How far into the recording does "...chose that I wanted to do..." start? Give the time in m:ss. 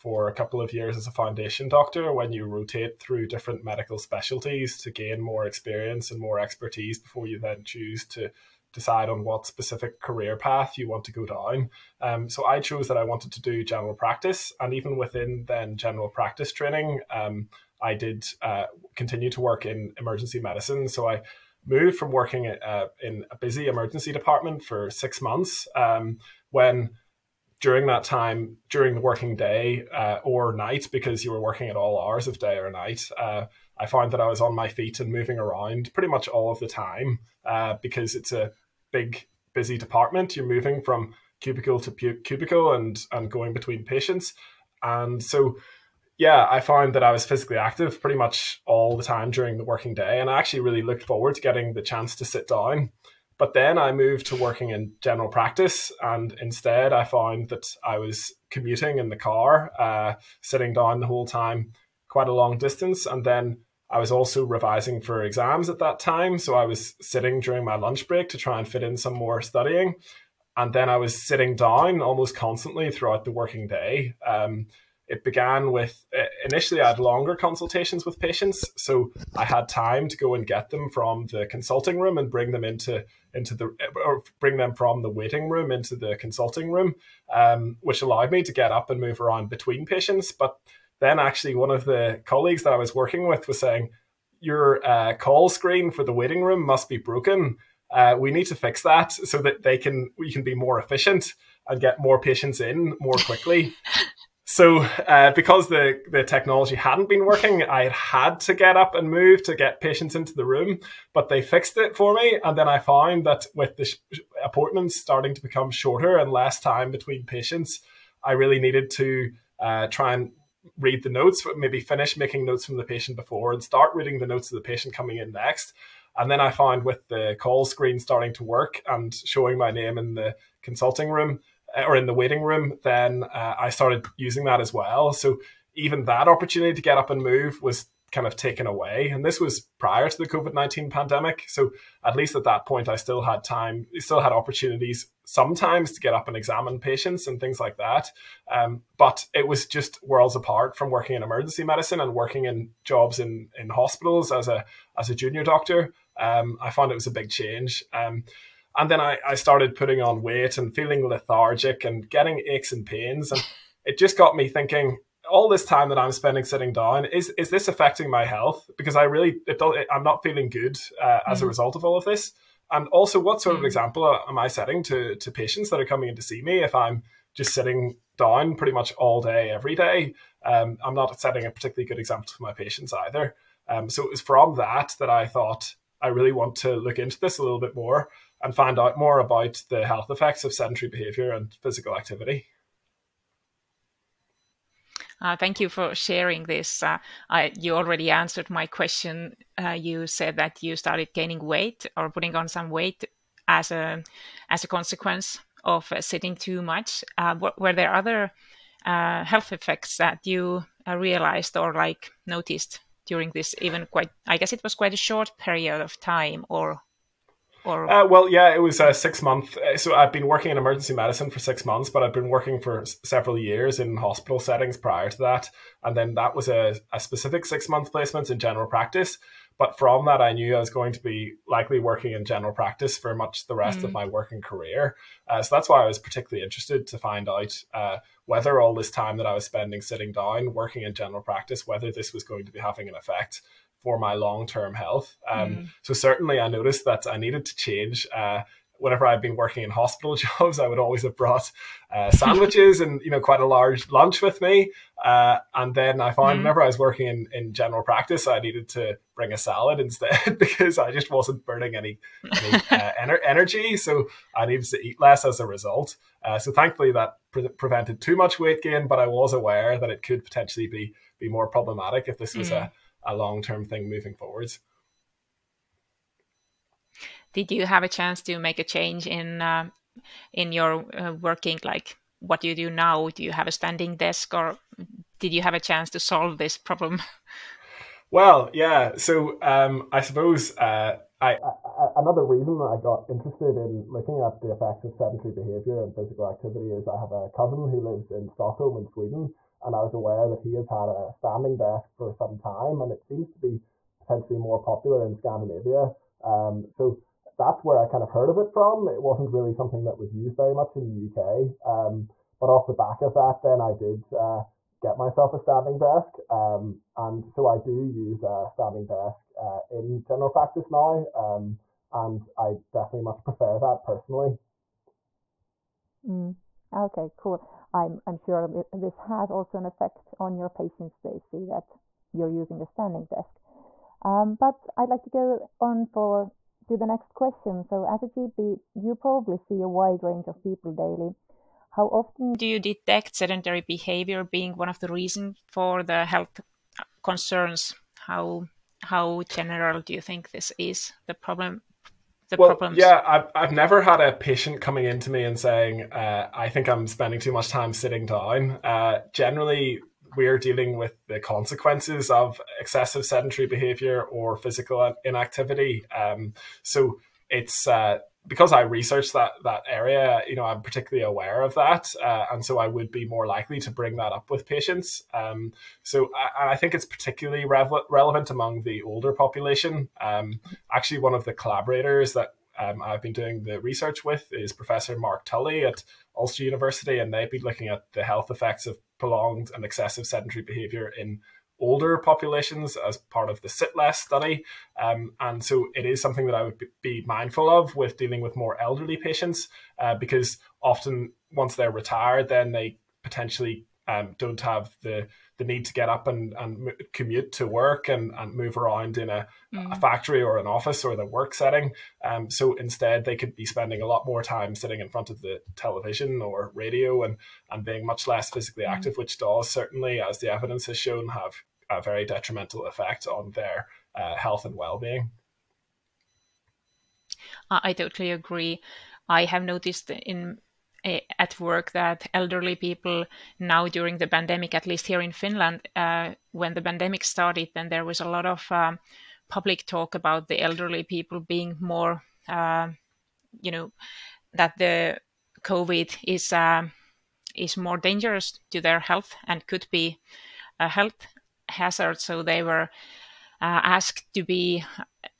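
0:12.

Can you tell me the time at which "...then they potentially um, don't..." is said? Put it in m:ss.
6:42.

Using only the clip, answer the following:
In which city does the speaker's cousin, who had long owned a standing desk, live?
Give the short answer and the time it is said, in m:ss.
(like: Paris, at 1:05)
Stockholm, at 4:58.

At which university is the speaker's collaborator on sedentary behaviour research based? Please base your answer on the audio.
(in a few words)
Ulster University.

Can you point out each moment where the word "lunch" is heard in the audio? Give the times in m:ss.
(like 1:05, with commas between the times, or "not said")
1:07, 4:13.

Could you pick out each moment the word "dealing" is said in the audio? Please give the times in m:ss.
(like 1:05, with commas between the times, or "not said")
6:00, 6:37.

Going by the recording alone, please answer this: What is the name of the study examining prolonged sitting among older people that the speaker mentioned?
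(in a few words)
SITLESS.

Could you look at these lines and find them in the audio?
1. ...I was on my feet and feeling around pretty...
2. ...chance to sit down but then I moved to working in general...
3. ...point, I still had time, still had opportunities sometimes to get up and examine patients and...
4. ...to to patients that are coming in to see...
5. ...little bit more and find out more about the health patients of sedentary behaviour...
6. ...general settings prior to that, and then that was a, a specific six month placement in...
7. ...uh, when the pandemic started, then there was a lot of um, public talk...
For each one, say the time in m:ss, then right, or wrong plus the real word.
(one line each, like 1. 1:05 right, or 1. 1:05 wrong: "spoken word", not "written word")
1. 0:34 wrong: "moving", not "feeling"
2. 0:51 right
3. 2:22 right
4. 2:54 right
5. 3:07 wrong: "effects", not "patients"
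6. 3:43 wrong: "hospital", not "general"
7. 7:15 right.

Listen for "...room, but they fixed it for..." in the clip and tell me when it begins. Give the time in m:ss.
1:50.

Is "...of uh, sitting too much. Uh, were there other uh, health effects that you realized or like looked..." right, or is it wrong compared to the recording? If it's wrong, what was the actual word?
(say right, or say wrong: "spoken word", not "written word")
wrong: "noticed", not "looked".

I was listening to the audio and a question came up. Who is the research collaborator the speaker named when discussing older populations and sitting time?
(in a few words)
Mark Tully.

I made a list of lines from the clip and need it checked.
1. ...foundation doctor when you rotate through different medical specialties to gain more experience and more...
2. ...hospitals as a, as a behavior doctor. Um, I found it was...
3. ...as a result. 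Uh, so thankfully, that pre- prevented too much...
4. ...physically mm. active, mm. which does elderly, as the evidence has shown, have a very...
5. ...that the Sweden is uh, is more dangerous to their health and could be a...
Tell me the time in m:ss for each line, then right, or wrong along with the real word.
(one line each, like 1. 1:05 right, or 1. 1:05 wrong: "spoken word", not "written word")
1. 0:01 right
2. 2:33 wrong: "junior", not "behavior"
3. 4:25 right
4. 6:58 wrong: "certainly", not "elderly"
5. 7:24 wrong: "COVID", not "Sweden".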